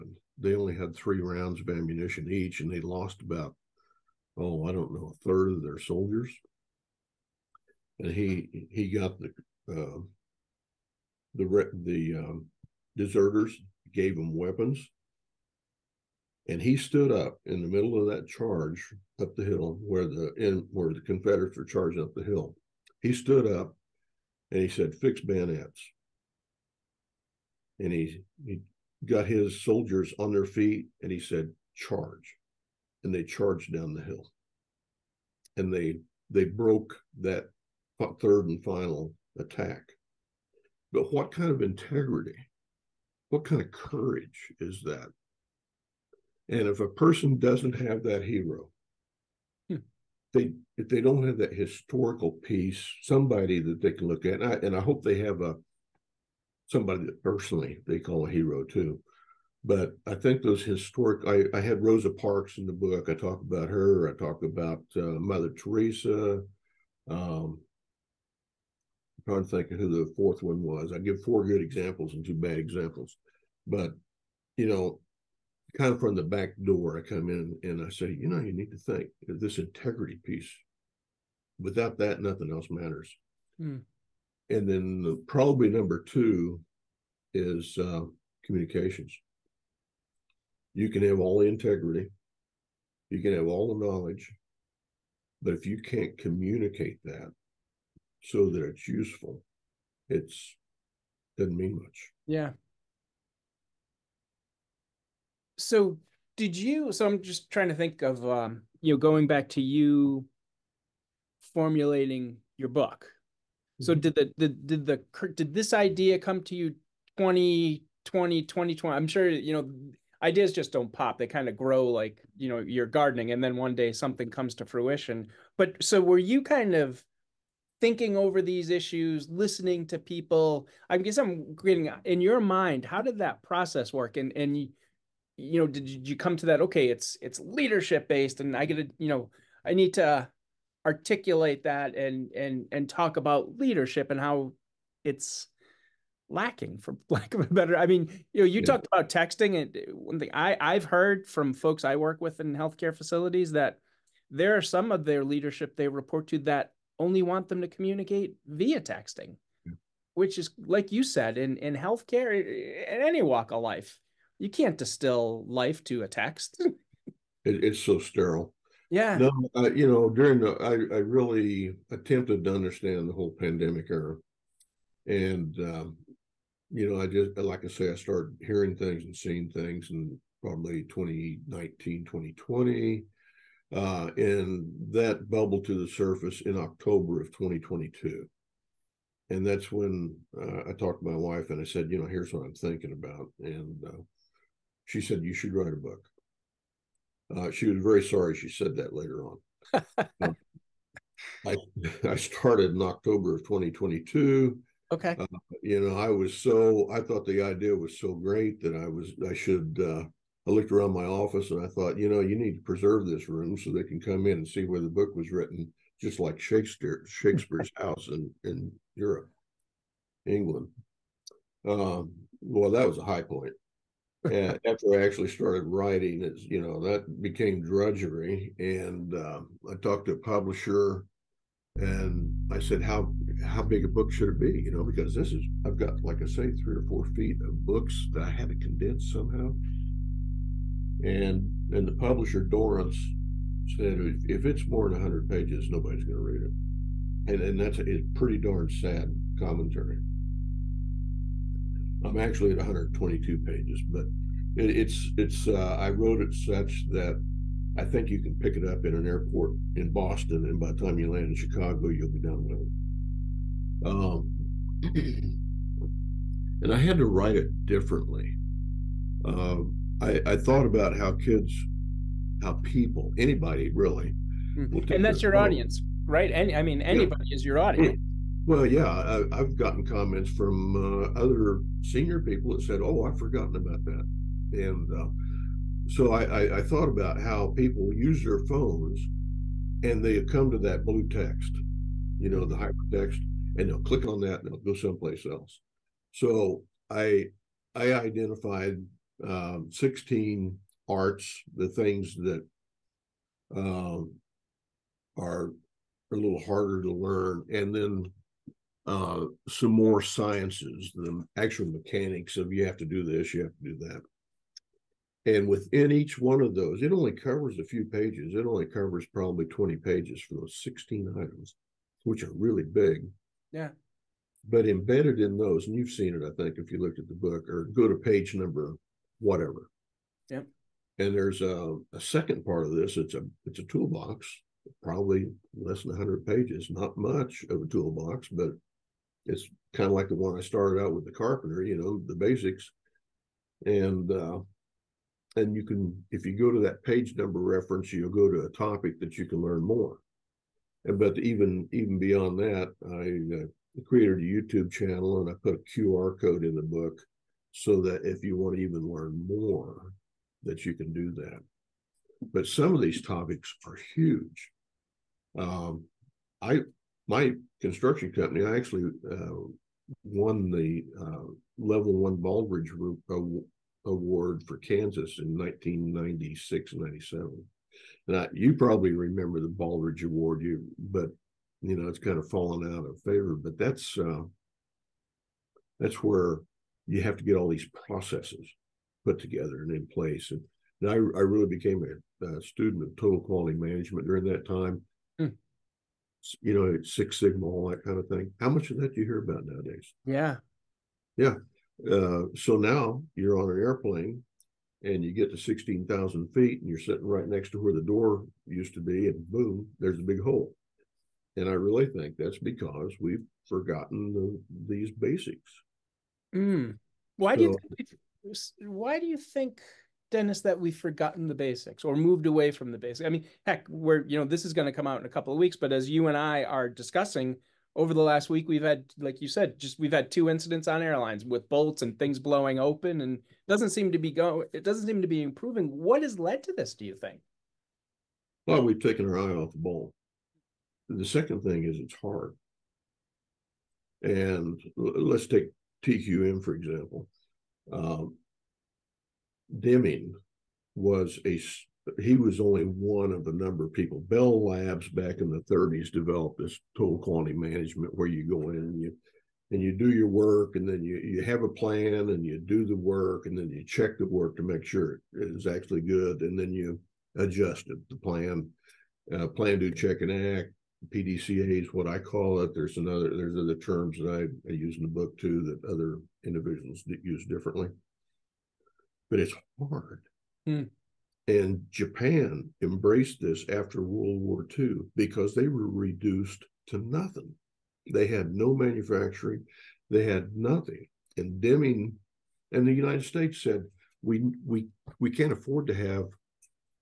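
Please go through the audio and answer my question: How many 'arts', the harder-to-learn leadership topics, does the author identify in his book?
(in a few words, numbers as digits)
16.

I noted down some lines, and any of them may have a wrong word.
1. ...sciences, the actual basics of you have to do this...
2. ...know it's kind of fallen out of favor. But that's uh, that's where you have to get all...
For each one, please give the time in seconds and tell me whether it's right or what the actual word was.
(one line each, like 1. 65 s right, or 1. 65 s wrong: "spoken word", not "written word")
1. 310 s wrong: "mechanics", not "basics"
2. 381 s right.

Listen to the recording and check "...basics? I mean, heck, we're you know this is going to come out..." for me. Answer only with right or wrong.
right.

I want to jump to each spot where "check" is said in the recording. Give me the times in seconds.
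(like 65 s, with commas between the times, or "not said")
463 s, 469 s.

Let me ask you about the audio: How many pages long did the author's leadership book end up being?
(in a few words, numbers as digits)
122.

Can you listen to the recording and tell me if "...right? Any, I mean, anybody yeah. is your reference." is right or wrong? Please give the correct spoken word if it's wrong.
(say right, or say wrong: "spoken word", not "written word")
wrong: "audience", not "reference".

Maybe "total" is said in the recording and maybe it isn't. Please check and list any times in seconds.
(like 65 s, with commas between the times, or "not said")
392 s, 456 s.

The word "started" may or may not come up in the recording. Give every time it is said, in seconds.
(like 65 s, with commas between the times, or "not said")
177 s, 202 s, 225 s, 340 s.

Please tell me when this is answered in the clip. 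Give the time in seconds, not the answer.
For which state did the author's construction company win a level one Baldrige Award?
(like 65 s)
374 s.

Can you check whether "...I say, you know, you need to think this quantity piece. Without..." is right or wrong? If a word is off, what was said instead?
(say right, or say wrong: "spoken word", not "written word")
wrong: "integrity", not "quantity".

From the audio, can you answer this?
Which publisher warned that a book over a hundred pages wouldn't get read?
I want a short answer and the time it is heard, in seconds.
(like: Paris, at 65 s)
Dorrance, at 242 s.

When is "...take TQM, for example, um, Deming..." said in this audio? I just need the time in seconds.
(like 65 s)
445 s.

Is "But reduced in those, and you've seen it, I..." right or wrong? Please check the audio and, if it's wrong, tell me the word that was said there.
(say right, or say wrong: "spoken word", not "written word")
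wrong: "embedded", not "reduced".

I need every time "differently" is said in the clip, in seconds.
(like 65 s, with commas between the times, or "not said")
267 s, 477 s.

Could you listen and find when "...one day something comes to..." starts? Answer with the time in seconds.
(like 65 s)
123 s.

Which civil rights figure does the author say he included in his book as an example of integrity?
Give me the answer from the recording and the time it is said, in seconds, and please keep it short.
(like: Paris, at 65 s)
Rosa Parks, at 61 s.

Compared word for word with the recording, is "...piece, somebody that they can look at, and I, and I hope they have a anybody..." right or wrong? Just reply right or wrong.
wrong.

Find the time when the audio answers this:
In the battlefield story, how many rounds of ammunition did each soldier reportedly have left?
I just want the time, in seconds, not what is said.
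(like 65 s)
0 s.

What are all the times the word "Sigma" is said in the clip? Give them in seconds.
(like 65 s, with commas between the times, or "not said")
397 s.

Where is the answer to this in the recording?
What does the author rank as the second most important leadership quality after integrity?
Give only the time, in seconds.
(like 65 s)
88 s.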